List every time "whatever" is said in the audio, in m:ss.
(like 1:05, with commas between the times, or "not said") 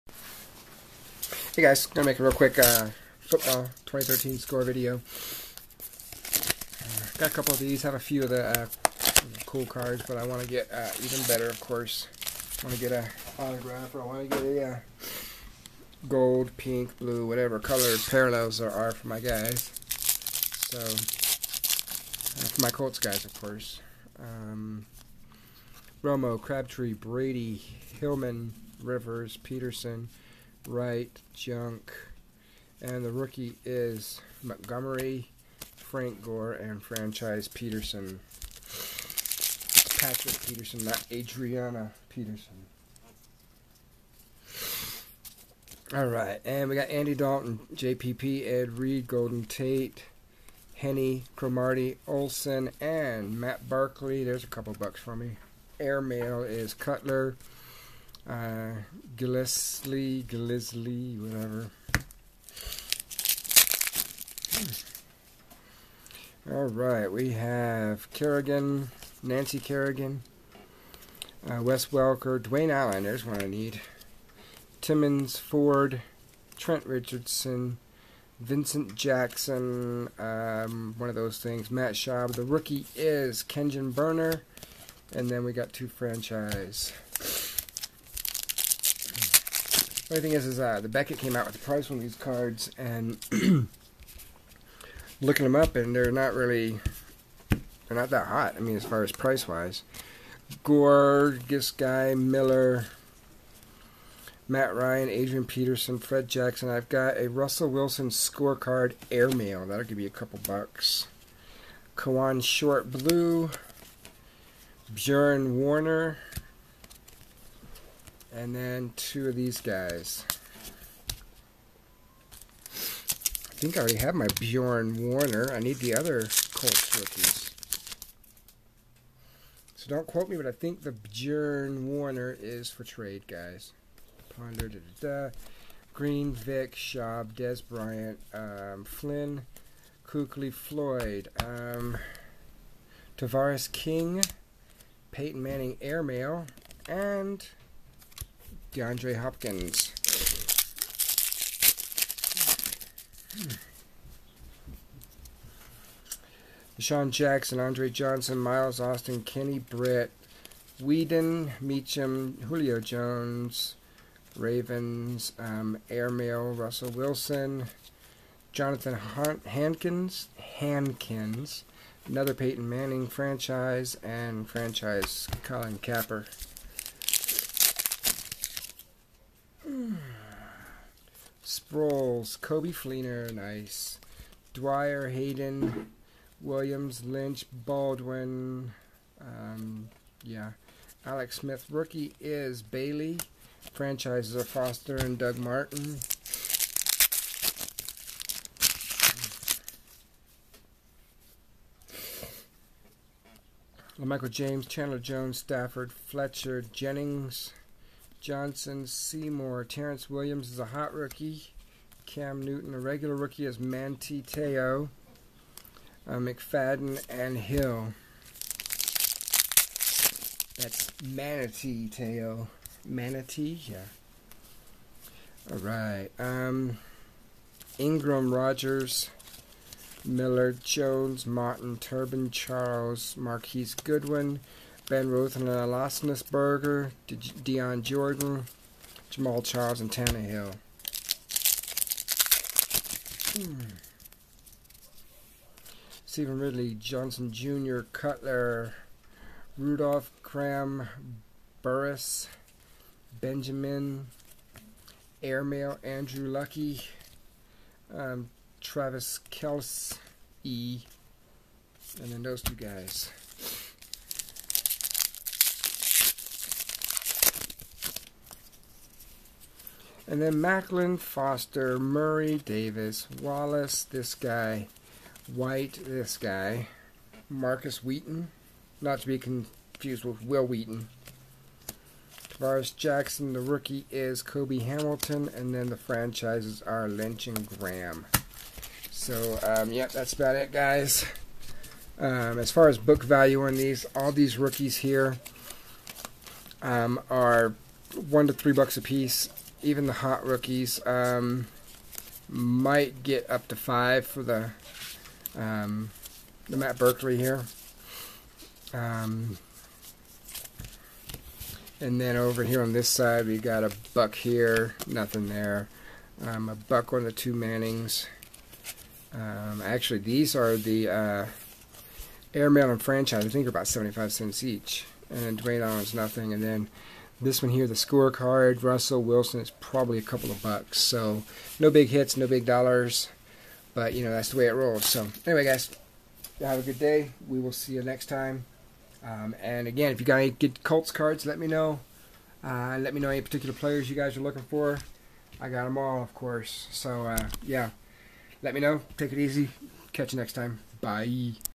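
0:17, 1:01.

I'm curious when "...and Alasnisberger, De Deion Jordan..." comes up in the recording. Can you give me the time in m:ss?
3:55.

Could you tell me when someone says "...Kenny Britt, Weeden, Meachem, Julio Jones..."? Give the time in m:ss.
2:39.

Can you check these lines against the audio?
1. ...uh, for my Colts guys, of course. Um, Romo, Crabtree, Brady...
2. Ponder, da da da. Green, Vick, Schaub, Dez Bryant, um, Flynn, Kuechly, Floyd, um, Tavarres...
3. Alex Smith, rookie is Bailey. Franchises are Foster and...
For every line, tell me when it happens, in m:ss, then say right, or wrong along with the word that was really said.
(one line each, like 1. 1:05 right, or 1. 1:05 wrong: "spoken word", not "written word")
1. 0:20 right
2. 2:14 right
3. 3:11 right.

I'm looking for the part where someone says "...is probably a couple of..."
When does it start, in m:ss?
5:29.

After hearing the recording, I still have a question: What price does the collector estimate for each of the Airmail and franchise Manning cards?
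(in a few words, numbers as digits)
75 cents.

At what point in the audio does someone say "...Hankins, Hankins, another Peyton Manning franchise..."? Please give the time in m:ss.
2:49.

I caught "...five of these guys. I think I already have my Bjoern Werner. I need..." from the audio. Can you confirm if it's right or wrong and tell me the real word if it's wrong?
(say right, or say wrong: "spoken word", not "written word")
wrong: "two", not "five".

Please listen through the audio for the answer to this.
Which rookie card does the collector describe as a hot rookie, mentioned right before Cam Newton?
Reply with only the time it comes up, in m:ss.
3:29.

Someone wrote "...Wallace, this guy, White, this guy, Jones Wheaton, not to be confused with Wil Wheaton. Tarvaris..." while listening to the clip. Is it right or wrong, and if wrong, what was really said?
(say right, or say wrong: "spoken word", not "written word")
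wrong: "Markus", not "Jones".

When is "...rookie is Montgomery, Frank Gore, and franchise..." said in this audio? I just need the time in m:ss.
0:33.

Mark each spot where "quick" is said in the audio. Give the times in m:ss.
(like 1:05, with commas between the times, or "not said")
0:02.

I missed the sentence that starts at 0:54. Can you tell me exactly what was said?
There's a couple bucks for me.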